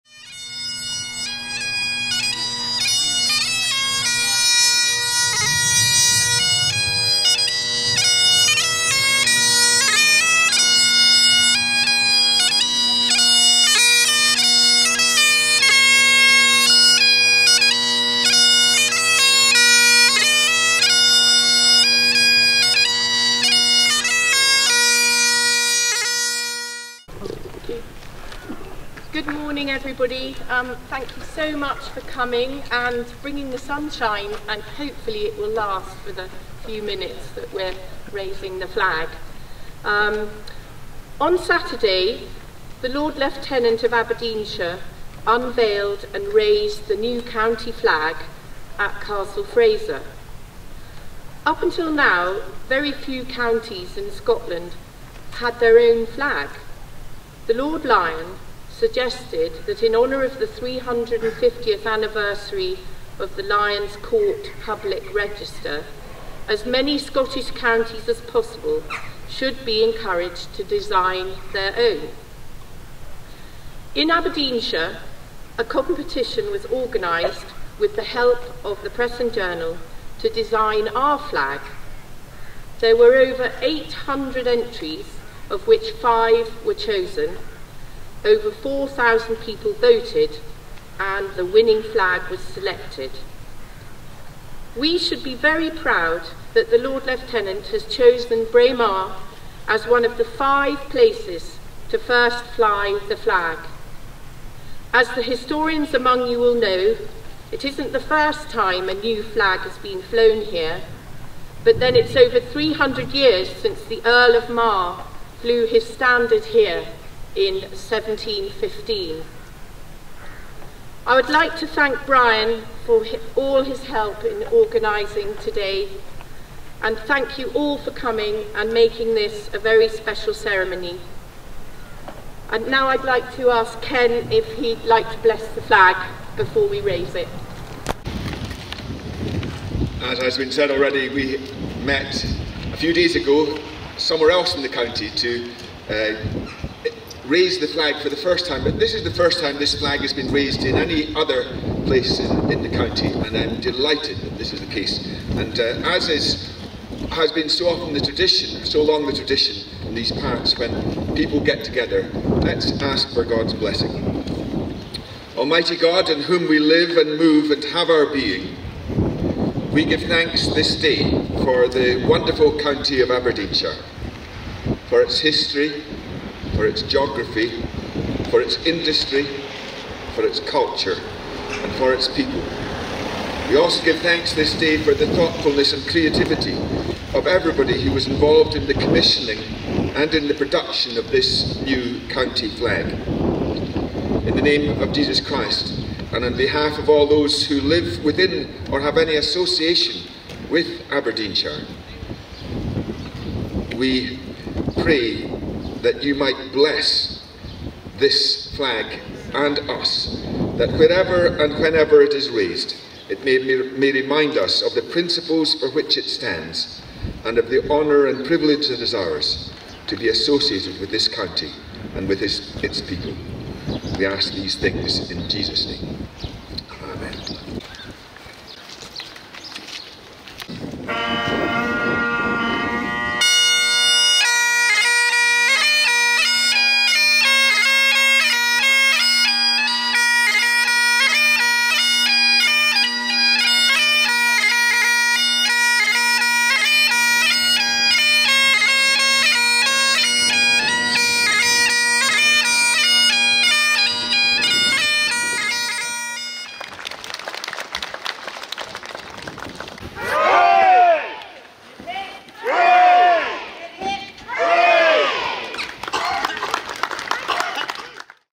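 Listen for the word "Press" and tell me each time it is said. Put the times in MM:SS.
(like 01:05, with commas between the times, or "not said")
01:18.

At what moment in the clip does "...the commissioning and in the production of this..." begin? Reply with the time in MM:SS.
03:08.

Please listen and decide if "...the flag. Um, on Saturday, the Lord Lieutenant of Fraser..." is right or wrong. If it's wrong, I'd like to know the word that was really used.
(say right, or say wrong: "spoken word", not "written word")
wrong: "Aberdeenshire", not "Fraser".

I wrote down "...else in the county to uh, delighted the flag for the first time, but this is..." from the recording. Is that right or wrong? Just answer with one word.
wrong.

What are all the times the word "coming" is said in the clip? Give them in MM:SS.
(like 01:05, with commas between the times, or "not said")
00:31, 02:07.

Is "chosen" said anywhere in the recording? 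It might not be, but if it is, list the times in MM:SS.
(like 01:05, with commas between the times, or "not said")
01:26, 01:37.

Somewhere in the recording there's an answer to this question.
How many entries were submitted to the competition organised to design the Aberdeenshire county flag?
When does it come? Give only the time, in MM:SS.
01:23.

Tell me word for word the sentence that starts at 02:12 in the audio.
And now I'd like to ask Ken if he'd like to bless the flag before we raise it.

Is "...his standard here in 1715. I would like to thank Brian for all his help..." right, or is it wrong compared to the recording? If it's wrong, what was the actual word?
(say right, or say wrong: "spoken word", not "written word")
right.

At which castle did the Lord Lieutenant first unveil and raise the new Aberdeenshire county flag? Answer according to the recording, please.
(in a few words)
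Castle Fraser.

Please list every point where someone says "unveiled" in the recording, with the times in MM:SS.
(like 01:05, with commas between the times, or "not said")
00:45.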